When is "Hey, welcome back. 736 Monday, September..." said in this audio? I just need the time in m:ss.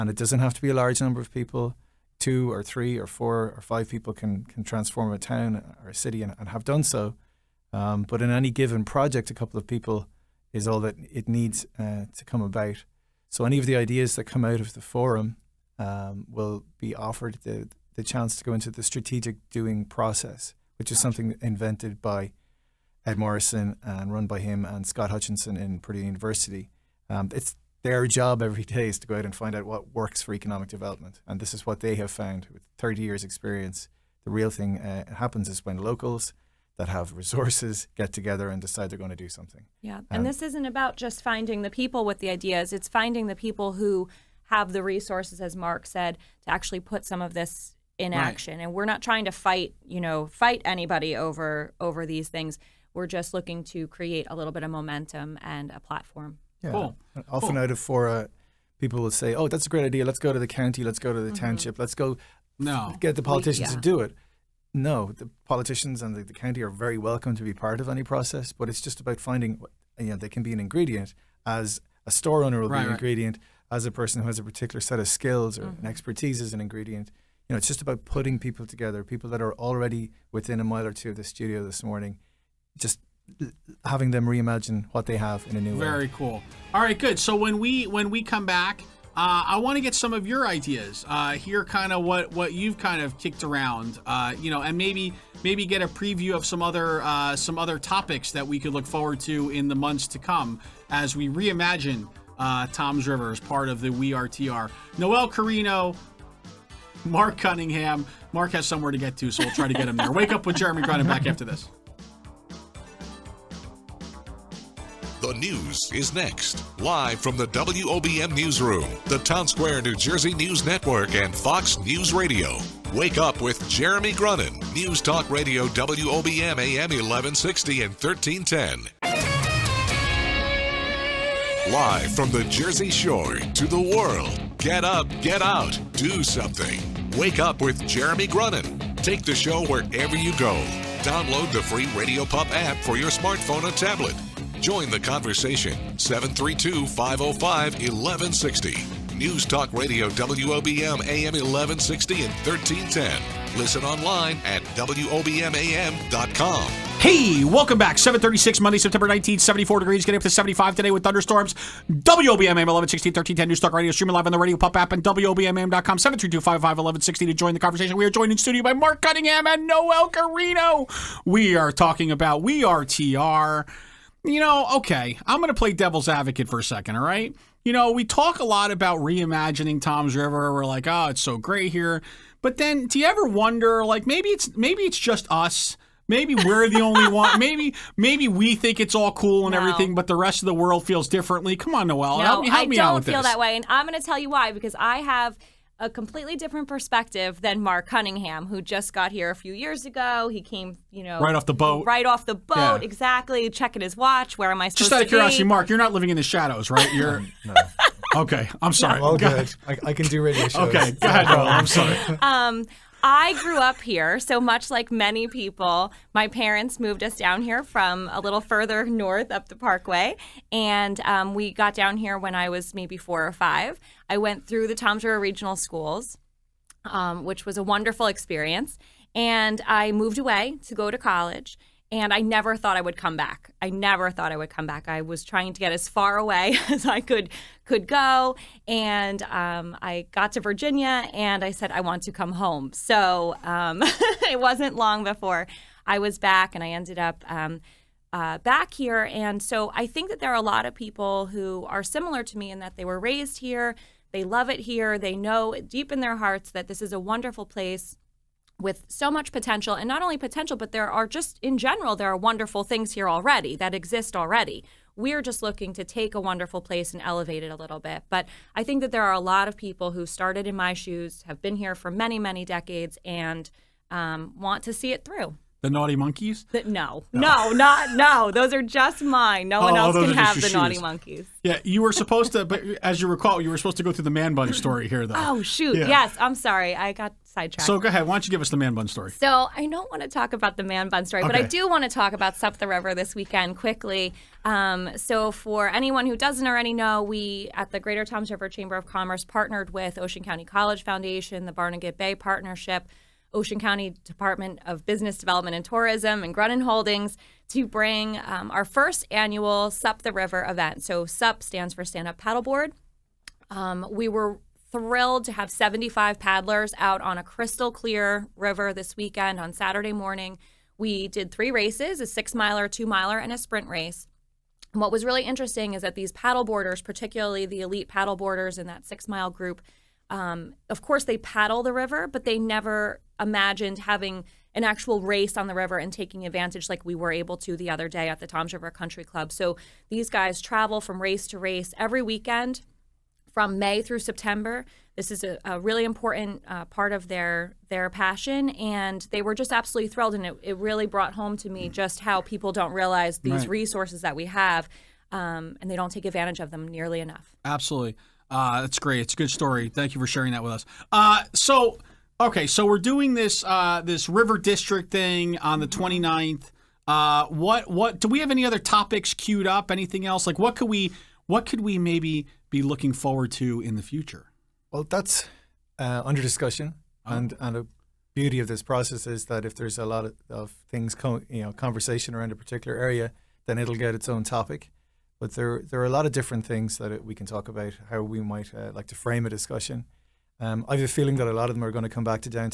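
2:37.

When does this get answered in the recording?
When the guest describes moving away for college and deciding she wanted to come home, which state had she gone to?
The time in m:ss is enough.
4:00.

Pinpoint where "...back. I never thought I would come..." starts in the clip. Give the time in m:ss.
3:53.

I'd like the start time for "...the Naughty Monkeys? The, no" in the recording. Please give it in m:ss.
4:35.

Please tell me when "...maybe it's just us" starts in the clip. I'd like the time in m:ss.
3:04.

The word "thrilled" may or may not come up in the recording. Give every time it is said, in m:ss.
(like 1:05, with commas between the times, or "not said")
5:14, 5:49.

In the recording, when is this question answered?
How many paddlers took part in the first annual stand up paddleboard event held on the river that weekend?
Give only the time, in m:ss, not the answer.
5:15.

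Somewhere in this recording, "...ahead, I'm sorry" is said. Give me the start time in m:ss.
3:31.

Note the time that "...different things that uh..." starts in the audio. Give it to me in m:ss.
6:26.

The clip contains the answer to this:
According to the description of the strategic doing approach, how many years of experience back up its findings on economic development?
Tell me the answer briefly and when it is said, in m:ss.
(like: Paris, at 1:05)
30, at 0:32.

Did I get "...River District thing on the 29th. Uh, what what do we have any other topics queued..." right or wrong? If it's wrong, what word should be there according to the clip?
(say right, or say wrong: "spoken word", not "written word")
right.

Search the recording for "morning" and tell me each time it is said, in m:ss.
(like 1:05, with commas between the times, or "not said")
1:21, 5:19.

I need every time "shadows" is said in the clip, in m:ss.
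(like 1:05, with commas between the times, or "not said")
3:26.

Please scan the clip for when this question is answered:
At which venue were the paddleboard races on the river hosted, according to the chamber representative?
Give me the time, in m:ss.
5:38.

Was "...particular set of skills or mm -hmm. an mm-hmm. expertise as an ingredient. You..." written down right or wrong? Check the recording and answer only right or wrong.
right.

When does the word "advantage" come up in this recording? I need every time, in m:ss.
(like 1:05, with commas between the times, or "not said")
5:36, 5:56.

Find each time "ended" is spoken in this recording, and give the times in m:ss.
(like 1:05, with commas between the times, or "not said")
4:06.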